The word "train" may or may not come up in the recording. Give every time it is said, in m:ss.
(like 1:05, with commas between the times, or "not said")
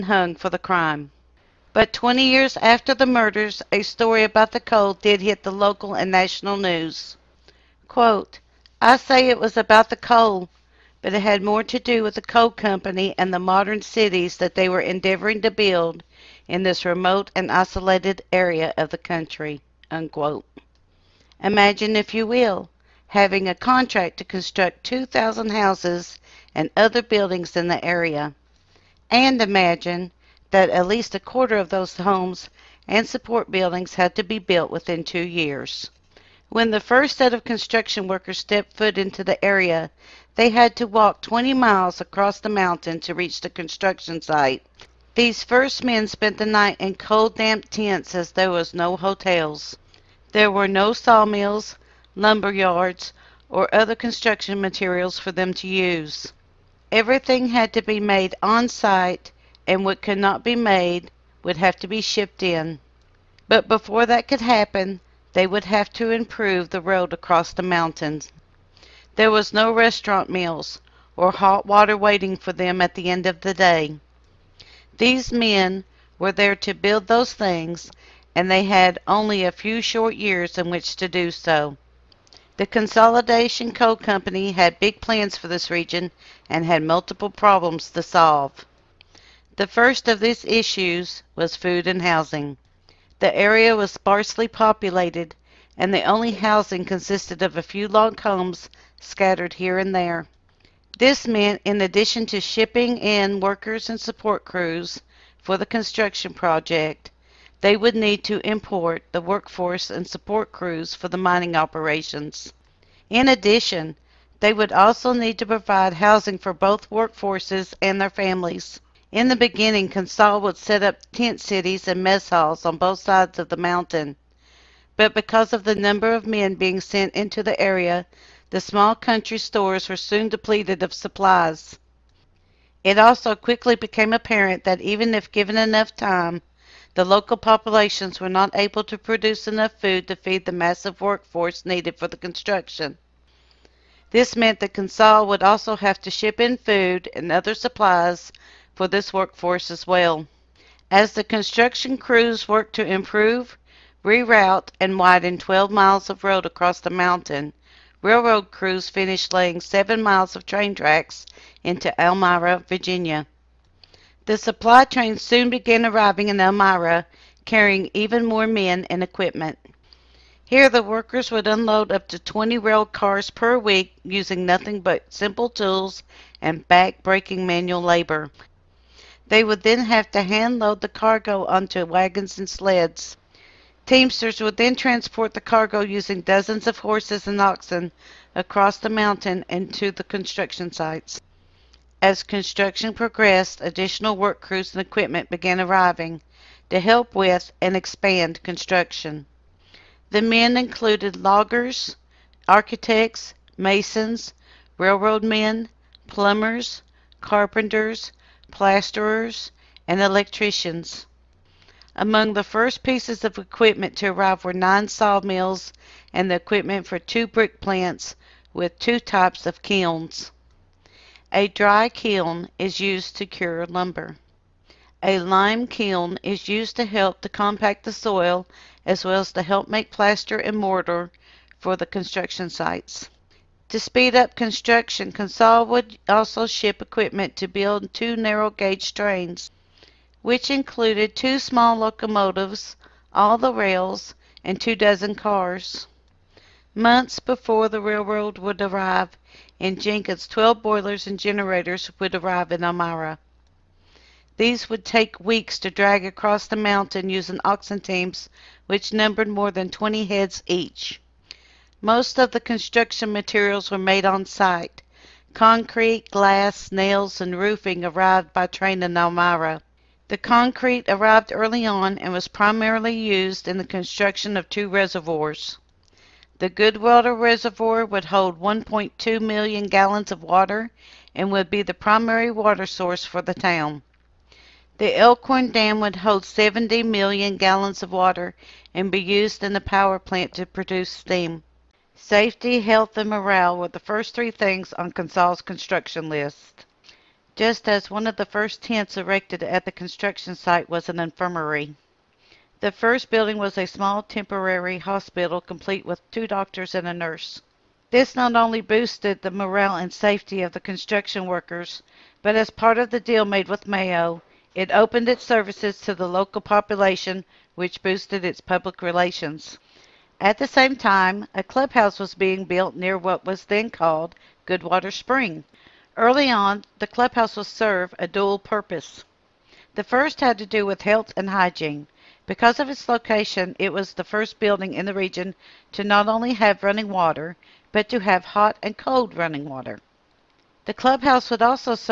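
2:40, 2:44, 3:58, 4:28.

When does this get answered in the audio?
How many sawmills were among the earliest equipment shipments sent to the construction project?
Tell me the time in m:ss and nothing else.
3:34.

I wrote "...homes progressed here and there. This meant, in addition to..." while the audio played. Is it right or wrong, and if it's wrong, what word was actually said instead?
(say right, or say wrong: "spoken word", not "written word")
wrong: "scattered", not "progressed".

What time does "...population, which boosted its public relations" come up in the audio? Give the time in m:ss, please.
5:16.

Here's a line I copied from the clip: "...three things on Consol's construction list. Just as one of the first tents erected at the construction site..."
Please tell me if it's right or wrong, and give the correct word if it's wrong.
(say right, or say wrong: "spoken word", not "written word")
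right.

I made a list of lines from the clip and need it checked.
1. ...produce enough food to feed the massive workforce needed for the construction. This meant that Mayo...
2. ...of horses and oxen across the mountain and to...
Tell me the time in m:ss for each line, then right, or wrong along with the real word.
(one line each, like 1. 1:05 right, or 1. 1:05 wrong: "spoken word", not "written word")
1. 2:18 wrong: "Consol", not "Mayo"
2. 3:06 right.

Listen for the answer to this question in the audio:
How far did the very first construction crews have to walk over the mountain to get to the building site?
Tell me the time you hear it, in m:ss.
0:41.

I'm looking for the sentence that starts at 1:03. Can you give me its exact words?
But before that could happen, they would have to improve the road across the mountains.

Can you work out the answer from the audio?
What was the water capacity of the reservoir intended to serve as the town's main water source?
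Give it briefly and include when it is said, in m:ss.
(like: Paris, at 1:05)
1.2 million gallons, at 4:38.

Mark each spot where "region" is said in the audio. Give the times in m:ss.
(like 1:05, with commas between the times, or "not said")
1:25, 5:34.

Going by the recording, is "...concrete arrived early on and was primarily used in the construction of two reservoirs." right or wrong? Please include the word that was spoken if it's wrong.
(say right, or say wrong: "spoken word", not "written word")
right.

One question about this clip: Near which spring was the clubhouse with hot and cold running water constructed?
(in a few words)
Goodwater Spring.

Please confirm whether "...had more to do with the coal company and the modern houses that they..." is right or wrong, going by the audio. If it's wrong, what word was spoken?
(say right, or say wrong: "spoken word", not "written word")
wrong: "cities", not "houses".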